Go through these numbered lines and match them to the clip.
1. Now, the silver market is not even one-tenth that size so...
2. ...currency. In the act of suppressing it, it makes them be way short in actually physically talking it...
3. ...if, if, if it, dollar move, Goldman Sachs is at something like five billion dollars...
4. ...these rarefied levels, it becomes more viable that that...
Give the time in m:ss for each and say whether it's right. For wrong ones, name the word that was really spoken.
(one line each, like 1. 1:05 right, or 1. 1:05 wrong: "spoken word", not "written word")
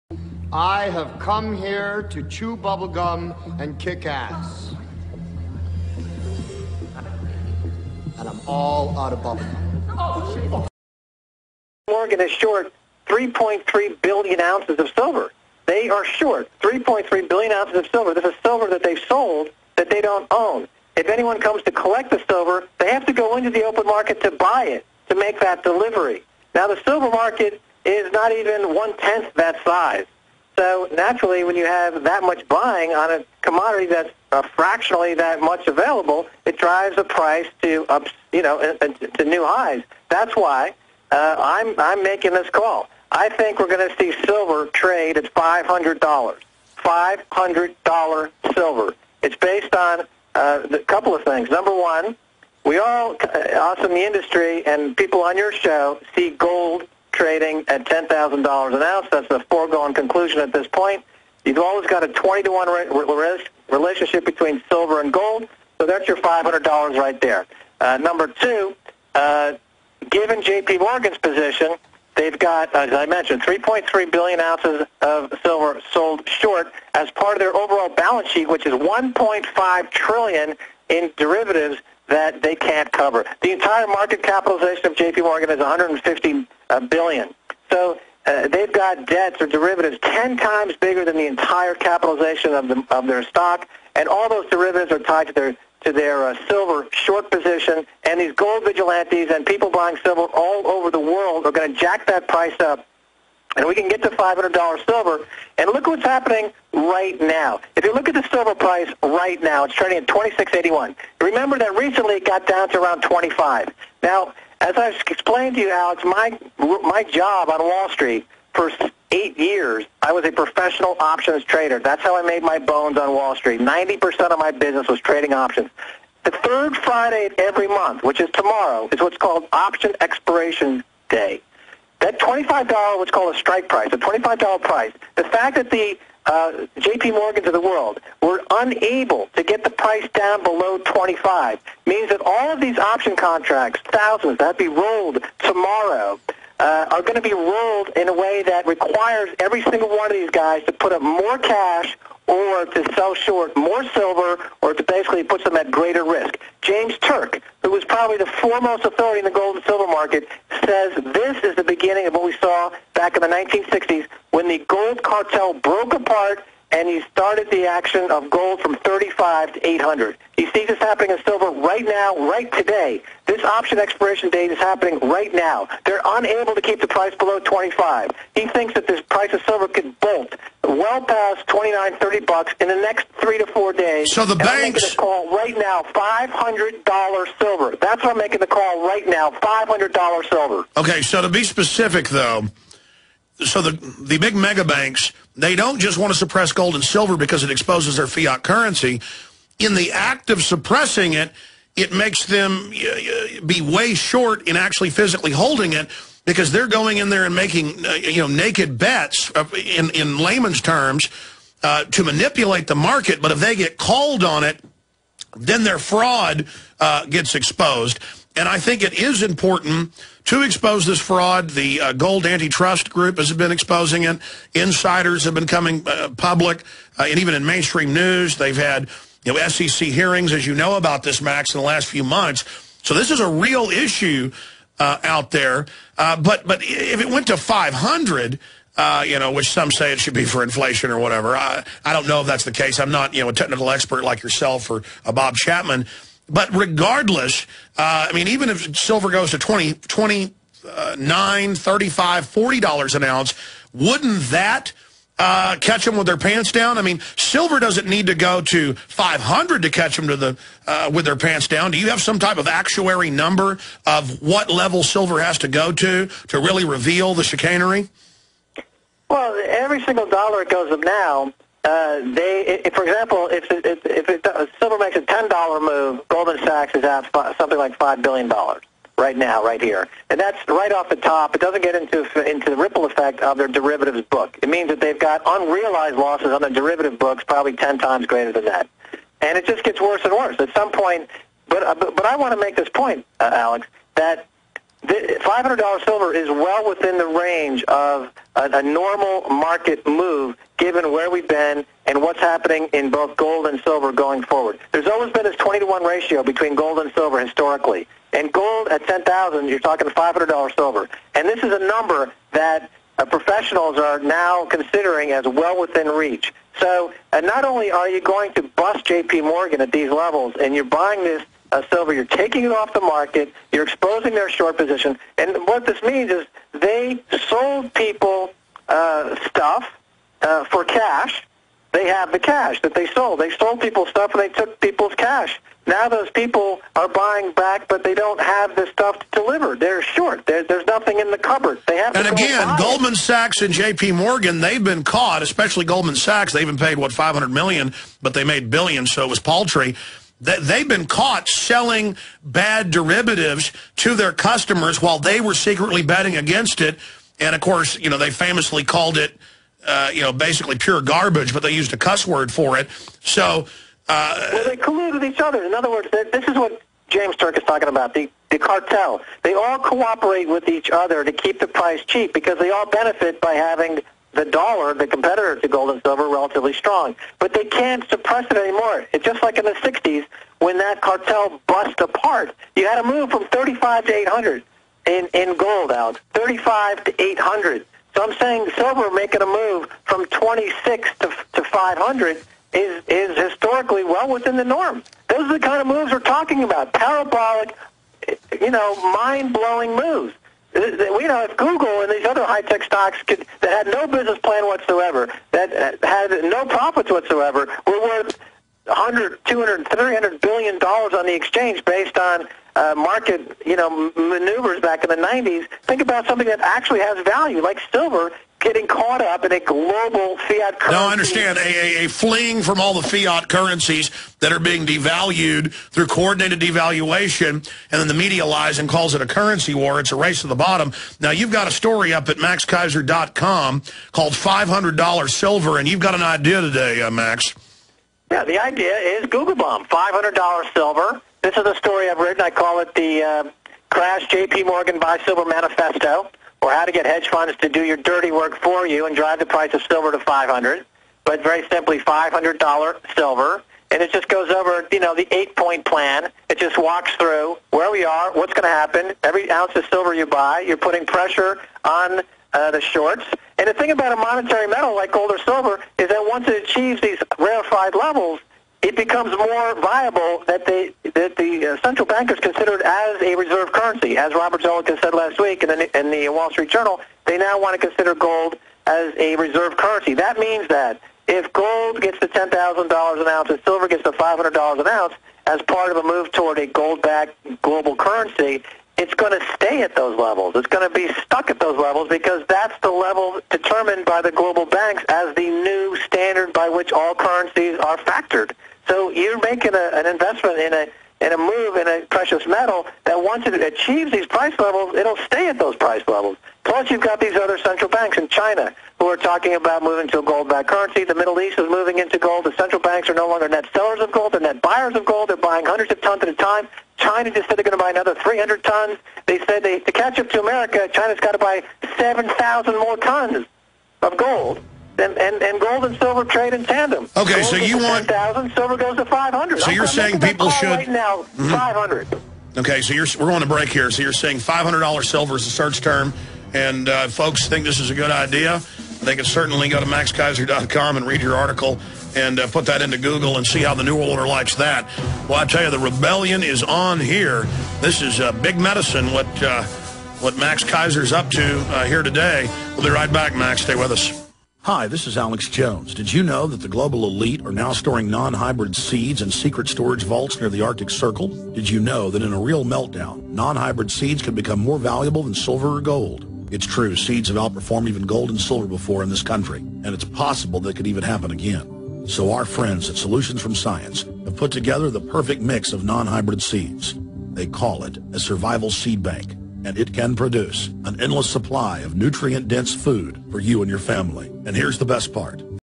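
1. 0:26 right
2. 3:18 wrong: "holding", not "talking"
3. 4:33 right
4. 7:46 right.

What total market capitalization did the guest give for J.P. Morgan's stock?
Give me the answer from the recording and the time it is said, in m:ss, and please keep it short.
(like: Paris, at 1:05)
150 billion, at 1:25.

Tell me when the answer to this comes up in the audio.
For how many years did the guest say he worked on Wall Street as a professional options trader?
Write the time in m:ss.
1:59.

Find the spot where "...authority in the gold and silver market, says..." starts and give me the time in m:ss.
2:38.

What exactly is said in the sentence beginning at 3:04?
So the and banks call right now $500 silver.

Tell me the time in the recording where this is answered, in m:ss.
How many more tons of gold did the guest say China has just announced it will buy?
8:37.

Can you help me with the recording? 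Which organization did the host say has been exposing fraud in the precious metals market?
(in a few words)
Gold Antitrust Group.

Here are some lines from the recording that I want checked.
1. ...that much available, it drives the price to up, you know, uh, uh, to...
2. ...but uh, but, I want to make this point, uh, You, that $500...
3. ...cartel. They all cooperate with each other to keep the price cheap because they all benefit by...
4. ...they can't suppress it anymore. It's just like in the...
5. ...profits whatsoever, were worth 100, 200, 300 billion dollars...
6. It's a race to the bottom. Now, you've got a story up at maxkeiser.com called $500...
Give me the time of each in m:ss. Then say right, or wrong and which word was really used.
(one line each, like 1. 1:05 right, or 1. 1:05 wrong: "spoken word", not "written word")
1. 0:35 right
2. 4:51 wrong: "Alex", not "You"
3. 6:08 right
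4. 6:17 right
5. 6:46 right
6. 7:09 right.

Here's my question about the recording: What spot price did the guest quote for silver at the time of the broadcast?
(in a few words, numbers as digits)
26.81.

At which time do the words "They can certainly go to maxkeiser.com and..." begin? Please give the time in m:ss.
8:58.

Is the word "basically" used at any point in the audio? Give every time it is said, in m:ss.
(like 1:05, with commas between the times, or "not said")
2:34, 6:00.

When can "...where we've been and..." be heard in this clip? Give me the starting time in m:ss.
5:00.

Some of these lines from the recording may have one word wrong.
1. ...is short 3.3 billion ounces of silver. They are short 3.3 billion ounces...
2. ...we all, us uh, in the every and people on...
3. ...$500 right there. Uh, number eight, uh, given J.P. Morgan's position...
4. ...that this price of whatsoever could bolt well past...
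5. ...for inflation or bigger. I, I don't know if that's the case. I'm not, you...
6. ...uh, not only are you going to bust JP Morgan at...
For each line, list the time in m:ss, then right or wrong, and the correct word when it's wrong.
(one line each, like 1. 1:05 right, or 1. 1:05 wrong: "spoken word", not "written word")
1. 0:12 right
2. 0:52 wrong: "industry", not "every"
3. 1:06 wrong: "two", not "eight"
4. 2:58 wrong: "silver", not "whatsoever"
5. 4:00 wrong: "whatever", not "bigger"
6. 5:17 right.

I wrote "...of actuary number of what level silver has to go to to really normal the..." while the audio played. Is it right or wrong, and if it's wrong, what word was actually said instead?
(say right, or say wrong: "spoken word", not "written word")
wrong: "reveal", not "normal".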